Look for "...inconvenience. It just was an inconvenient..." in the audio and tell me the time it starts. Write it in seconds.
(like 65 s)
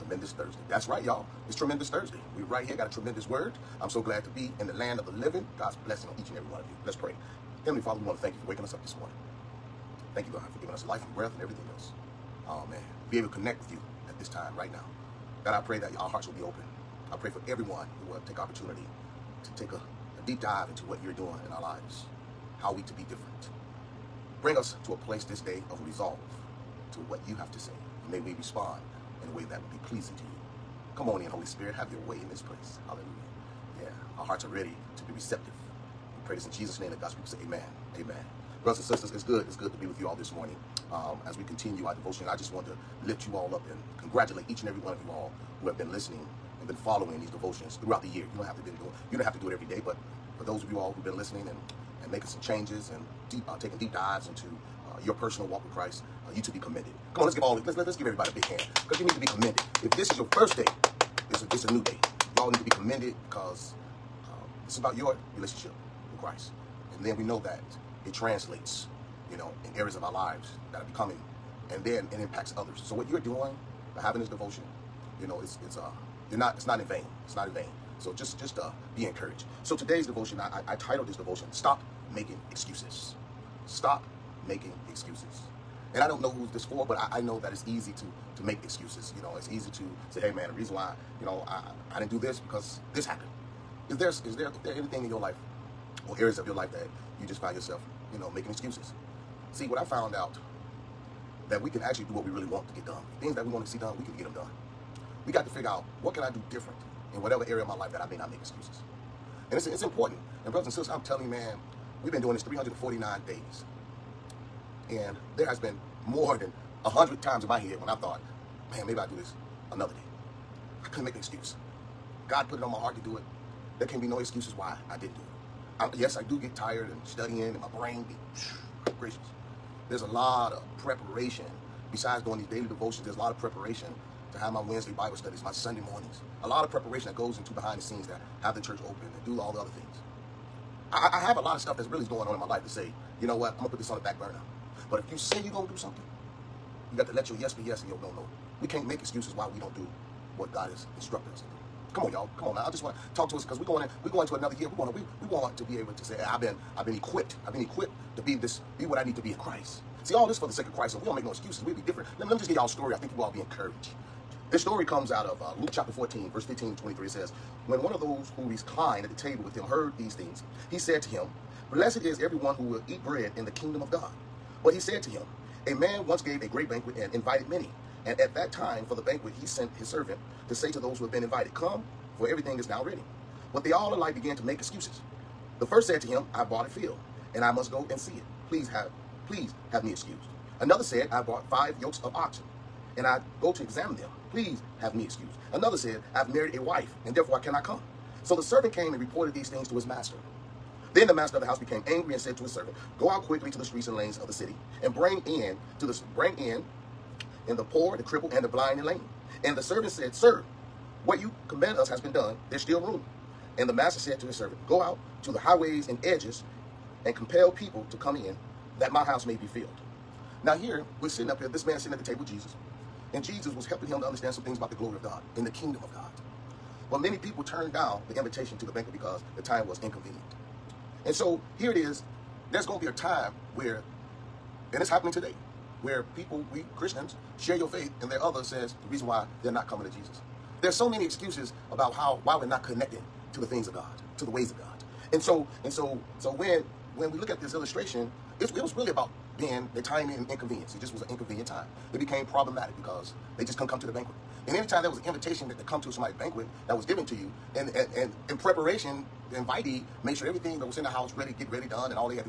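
250 s.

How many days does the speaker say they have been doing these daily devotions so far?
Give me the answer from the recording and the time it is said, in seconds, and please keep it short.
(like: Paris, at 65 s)
349, at 112 s.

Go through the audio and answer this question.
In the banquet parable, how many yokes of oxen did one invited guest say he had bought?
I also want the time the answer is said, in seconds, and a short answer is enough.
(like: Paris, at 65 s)
5, at 191 s.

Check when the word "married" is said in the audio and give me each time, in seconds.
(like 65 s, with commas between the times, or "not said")
196 s.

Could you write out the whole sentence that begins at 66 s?
And then we know that it translates, you know, in areas of our lives that are becoming, and then it impacts others.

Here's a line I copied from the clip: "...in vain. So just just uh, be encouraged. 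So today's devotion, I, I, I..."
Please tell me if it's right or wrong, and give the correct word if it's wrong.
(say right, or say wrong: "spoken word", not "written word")
right.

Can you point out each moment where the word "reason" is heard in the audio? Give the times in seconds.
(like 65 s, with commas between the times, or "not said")
90 s, 238 s.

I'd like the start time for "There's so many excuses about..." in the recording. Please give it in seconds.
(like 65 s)
240 s.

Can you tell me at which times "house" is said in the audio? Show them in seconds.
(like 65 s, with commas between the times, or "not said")
201 s, 219 s, 260 s.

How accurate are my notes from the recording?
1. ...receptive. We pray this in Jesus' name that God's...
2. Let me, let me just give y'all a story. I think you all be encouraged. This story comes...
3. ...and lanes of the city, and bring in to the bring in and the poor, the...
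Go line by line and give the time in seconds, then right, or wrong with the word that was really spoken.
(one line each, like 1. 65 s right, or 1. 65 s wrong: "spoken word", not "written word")
1. 35 s right
2. 162 s right
3. 203 s right.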